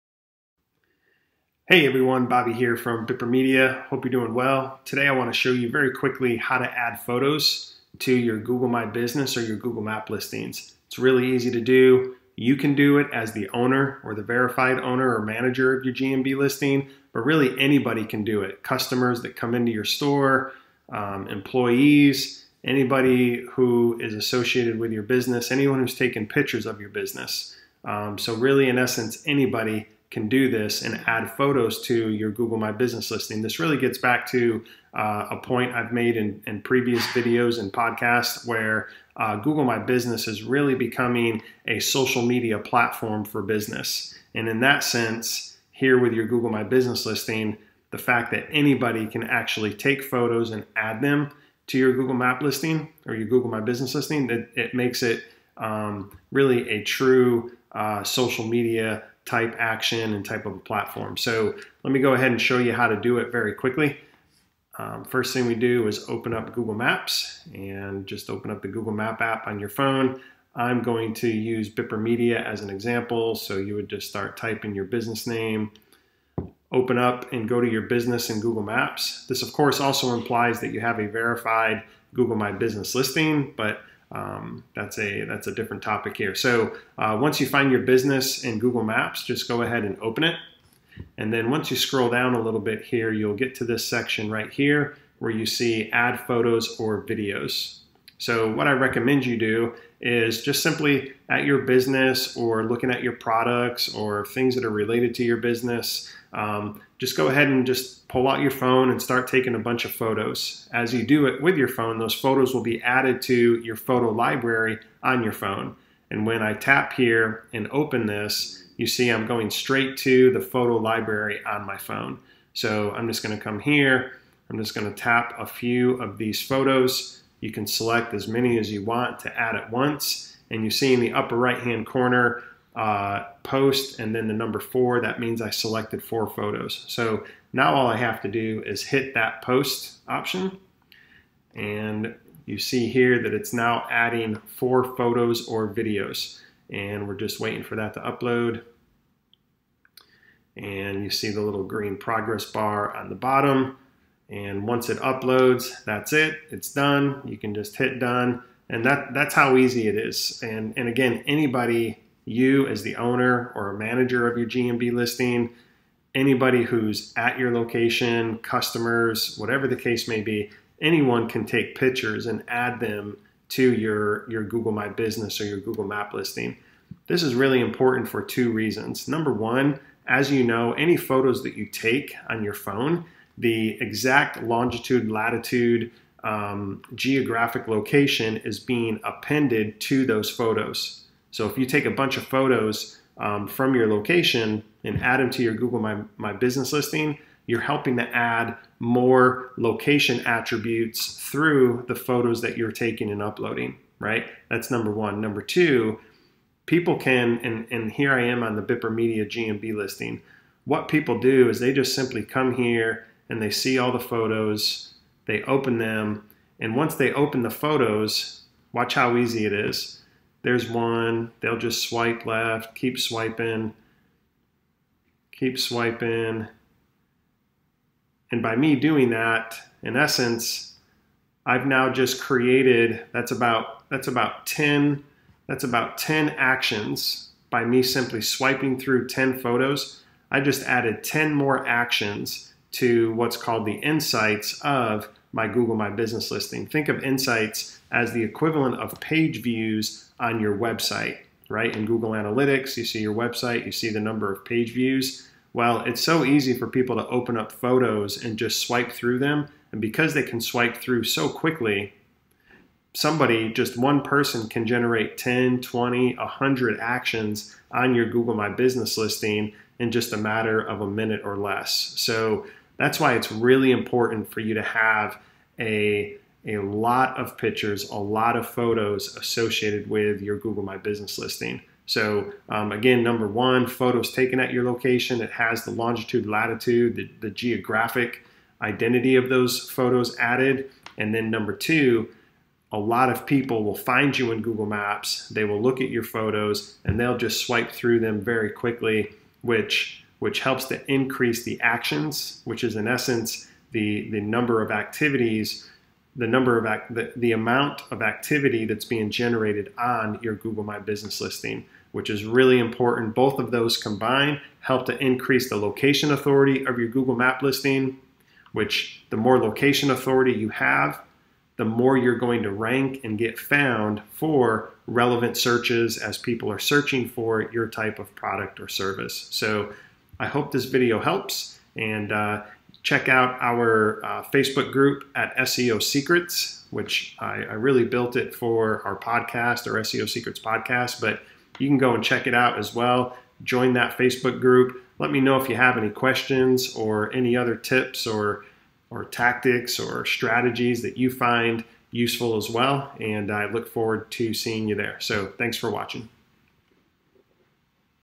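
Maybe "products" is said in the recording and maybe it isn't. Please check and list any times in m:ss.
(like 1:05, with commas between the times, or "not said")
1:43, 5:28.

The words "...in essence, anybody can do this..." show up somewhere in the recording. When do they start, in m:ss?
0:28.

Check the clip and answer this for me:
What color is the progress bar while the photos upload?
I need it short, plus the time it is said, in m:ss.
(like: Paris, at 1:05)
Green, at 2:31.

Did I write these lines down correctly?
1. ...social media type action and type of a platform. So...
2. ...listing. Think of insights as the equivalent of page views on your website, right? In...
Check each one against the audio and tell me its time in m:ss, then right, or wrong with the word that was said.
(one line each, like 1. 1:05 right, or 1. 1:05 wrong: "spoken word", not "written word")
1. 0:58 right
2. 4:06 right.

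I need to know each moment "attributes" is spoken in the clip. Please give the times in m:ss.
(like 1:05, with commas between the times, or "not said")
3:20.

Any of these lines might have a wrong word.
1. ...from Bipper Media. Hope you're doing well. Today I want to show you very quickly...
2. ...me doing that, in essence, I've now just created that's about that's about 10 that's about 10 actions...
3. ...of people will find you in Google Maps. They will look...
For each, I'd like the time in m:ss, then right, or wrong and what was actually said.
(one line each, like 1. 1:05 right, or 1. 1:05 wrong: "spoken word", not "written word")
1. 0:02 right
2. 3:48 right
3. 4:53 right.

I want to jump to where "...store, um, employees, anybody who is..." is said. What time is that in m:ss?
0:19.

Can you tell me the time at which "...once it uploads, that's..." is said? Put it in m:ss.
2:34.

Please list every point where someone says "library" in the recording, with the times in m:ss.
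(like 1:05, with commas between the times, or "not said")
1:54, 2:00.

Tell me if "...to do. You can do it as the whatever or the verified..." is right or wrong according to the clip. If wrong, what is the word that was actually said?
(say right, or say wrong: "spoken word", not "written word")
wrong: "owner", not "whatever".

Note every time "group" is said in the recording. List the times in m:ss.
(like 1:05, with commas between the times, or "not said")
5:34, 5:44.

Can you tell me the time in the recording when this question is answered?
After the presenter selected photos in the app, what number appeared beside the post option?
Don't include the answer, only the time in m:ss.
2:13.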